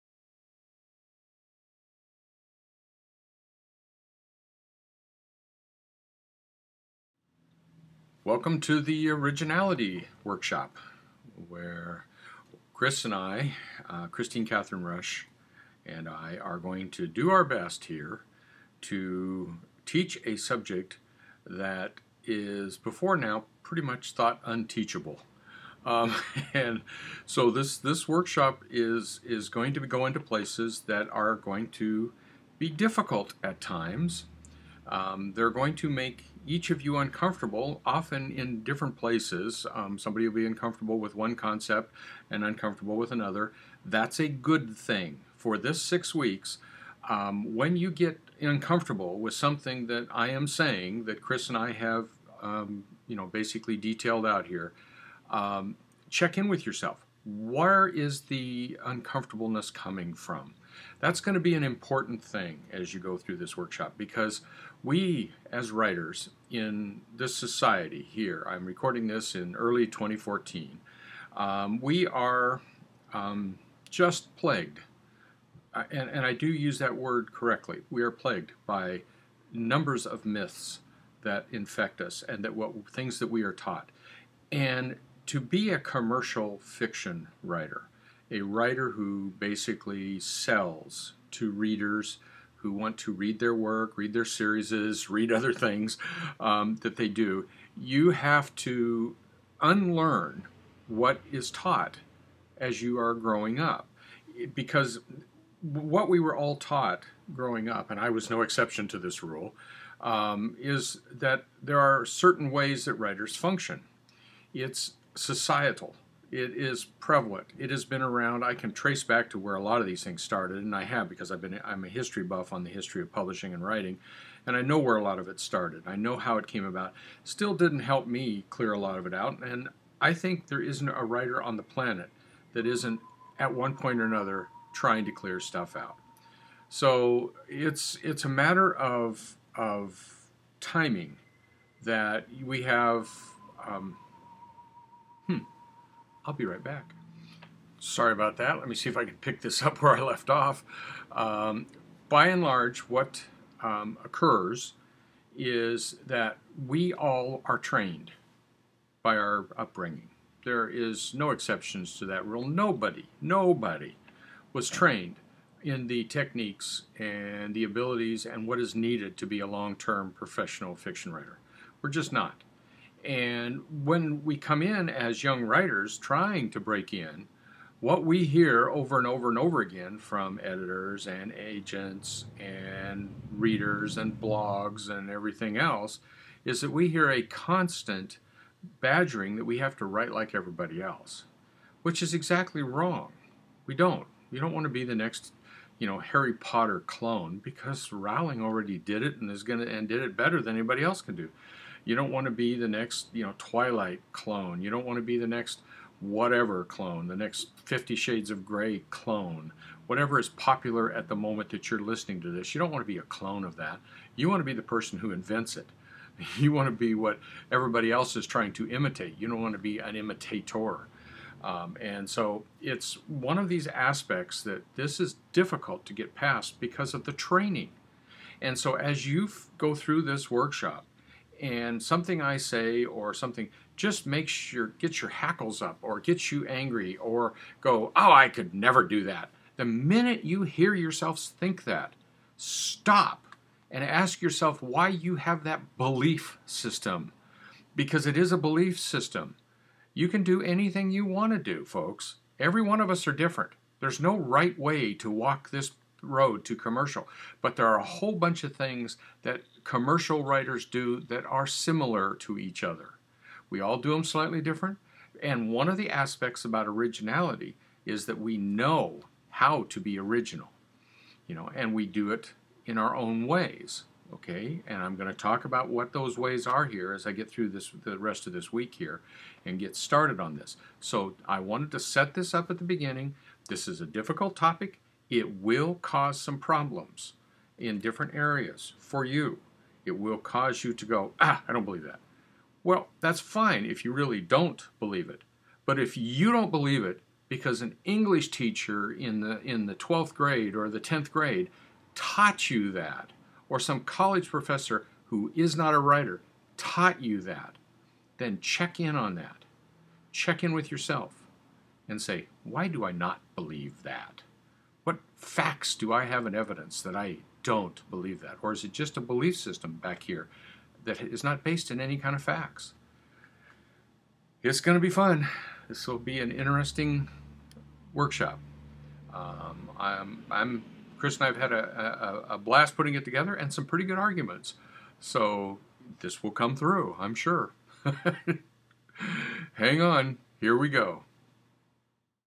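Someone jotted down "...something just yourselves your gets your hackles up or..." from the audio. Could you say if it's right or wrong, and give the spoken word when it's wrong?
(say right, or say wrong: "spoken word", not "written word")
wrong: "makes", not "yourselves".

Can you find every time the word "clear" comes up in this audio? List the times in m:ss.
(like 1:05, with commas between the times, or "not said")
2:08, 2:15.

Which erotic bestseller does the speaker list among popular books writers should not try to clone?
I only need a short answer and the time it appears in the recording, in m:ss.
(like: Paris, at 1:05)
50 Shades of Grey, at 3:27.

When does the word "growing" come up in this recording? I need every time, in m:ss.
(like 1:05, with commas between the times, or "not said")
1:43, 1:47.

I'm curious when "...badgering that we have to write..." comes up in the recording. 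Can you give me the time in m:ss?
3:08.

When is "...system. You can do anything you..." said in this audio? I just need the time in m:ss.
4:08.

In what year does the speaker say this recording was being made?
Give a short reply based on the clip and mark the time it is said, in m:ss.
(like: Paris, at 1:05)
2014, at 1:09.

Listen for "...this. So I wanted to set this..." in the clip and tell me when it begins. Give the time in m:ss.
4:40.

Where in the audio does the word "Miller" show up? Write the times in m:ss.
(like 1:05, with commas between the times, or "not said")
not said.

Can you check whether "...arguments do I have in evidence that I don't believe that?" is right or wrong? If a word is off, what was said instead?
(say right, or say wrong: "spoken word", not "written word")
wrong: "facts", not "arguments".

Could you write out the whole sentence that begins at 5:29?
Um, I'm, I'm, Kris and I have had a, a, a blast putting it together and some pretty good arguments.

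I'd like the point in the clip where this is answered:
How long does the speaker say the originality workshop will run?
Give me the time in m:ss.
0:45.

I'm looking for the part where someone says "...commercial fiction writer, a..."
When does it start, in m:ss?
1:25.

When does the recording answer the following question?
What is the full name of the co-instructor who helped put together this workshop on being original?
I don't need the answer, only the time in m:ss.
0:14.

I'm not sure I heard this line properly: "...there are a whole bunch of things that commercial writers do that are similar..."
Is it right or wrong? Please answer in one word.
right.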